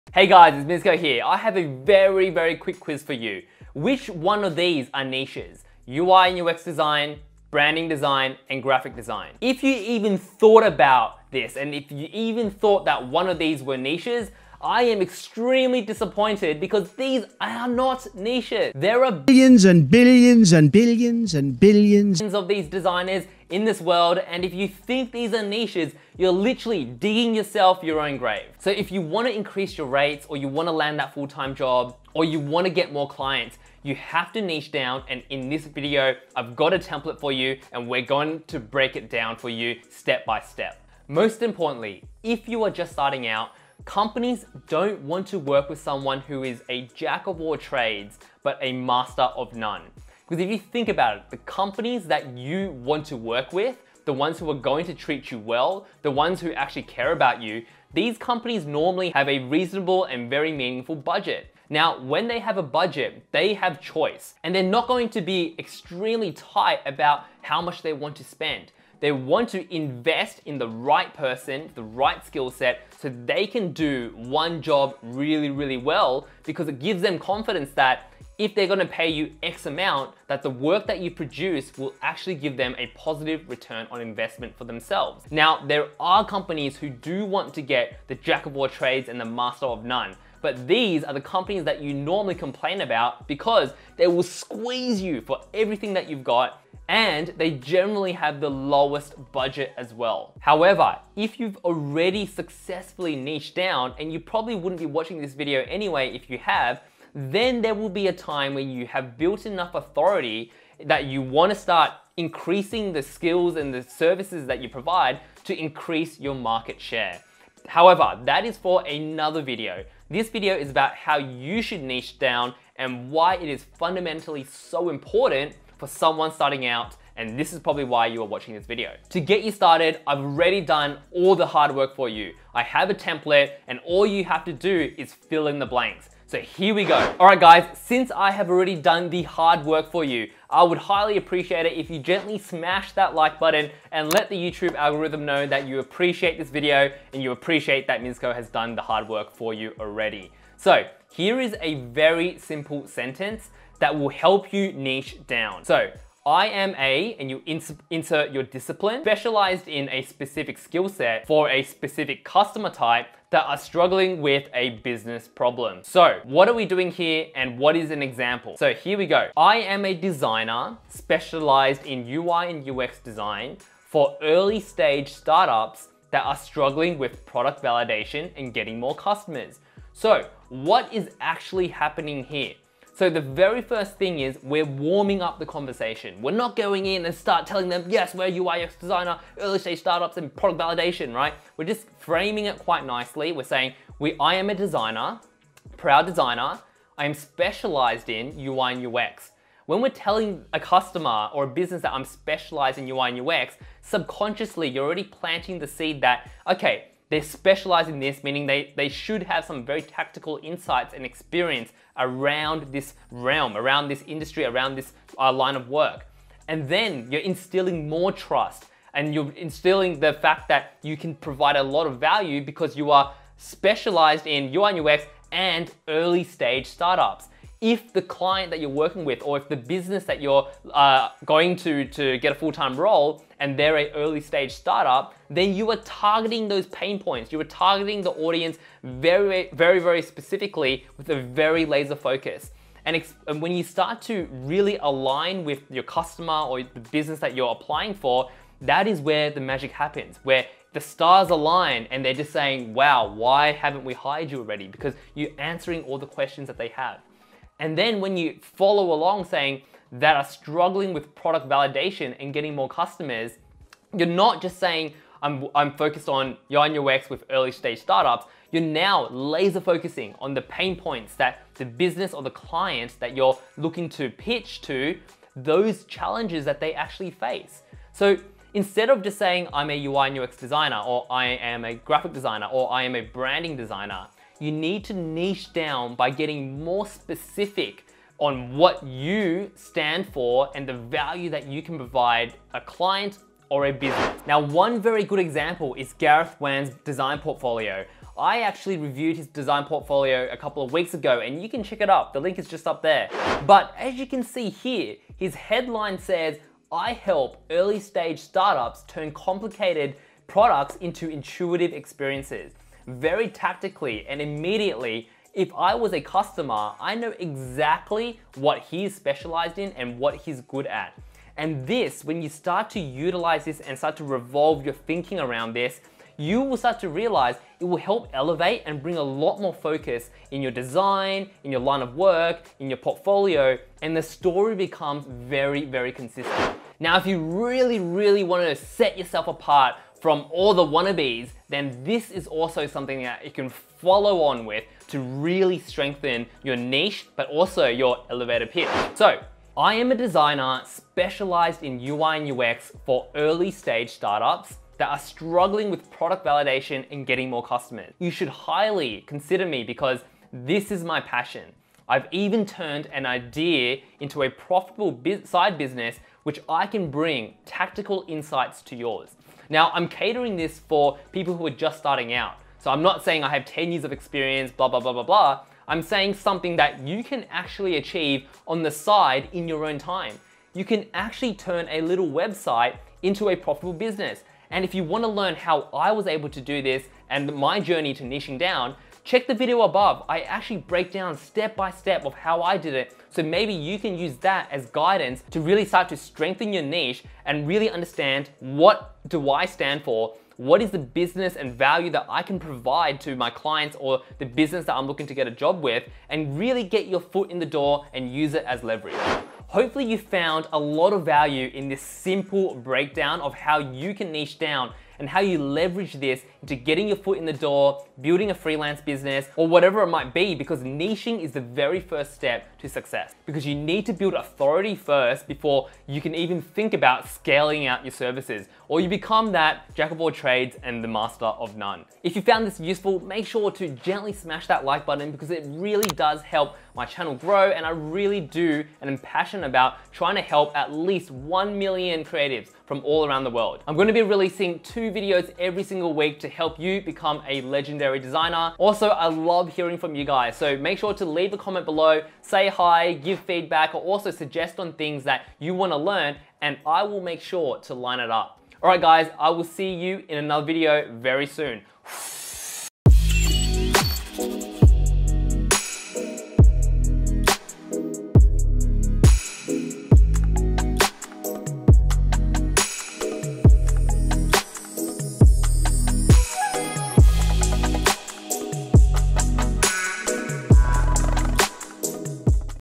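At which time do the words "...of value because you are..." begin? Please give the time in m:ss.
3:41.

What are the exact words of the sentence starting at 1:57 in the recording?
However, that is for another video.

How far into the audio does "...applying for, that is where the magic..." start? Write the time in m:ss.
4:07.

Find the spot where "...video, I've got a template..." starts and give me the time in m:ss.
0:35.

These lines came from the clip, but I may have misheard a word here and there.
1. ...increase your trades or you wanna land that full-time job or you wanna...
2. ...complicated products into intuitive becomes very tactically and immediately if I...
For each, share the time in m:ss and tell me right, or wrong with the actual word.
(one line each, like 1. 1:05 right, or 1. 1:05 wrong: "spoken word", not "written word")
1. 0:29 wrong: "rates", not "trades"
2. 5:09 wrong: "experiences", not "becomes".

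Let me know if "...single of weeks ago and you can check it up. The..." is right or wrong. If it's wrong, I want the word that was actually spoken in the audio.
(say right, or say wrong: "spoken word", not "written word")
wrong: "couple", not "single".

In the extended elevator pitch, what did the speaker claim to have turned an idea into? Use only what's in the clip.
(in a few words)
a profitable side business.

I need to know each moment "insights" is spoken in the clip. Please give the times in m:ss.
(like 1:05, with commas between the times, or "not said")
3:30, 6:08.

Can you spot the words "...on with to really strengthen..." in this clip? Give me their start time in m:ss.
5:44.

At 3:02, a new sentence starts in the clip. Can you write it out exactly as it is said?
So the very first thing is we're warming up the conversation.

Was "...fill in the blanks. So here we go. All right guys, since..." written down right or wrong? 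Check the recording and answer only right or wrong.
right.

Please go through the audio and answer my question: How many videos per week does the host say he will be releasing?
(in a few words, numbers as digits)
2.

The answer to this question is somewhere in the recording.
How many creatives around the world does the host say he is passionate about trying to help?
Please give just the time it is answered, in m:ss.
7:21.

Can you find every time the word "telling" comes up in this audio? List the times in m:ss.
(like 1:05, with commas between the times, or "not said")
3:07, 3:19.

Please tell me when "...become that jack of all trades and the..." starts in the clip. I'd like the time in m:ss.
7:08.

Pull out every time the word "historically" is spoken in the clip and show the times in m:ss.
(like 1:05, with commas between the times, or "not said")
not said.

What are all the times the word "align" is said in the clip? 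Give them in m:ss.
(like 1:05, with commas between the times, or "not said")
4:04, 4:11.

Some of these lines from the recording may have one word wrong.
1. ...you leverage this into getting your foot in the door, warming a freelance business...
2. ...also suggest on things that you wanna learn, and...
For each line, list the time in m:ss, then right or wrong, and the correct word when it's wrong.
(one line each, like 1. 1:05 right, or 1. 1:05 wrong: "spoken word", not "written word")
1. 6:55 wrong: "building", not "warming"
2. 7:33 right.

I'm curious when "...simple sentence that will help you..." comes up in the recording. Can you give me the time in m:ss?
2:32.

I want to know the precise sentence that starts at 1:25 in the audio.
Now, there are companies who do want to get the jack of all trades and the master of none.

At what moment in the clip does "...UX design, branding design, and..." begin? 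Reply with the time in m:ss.
0:06.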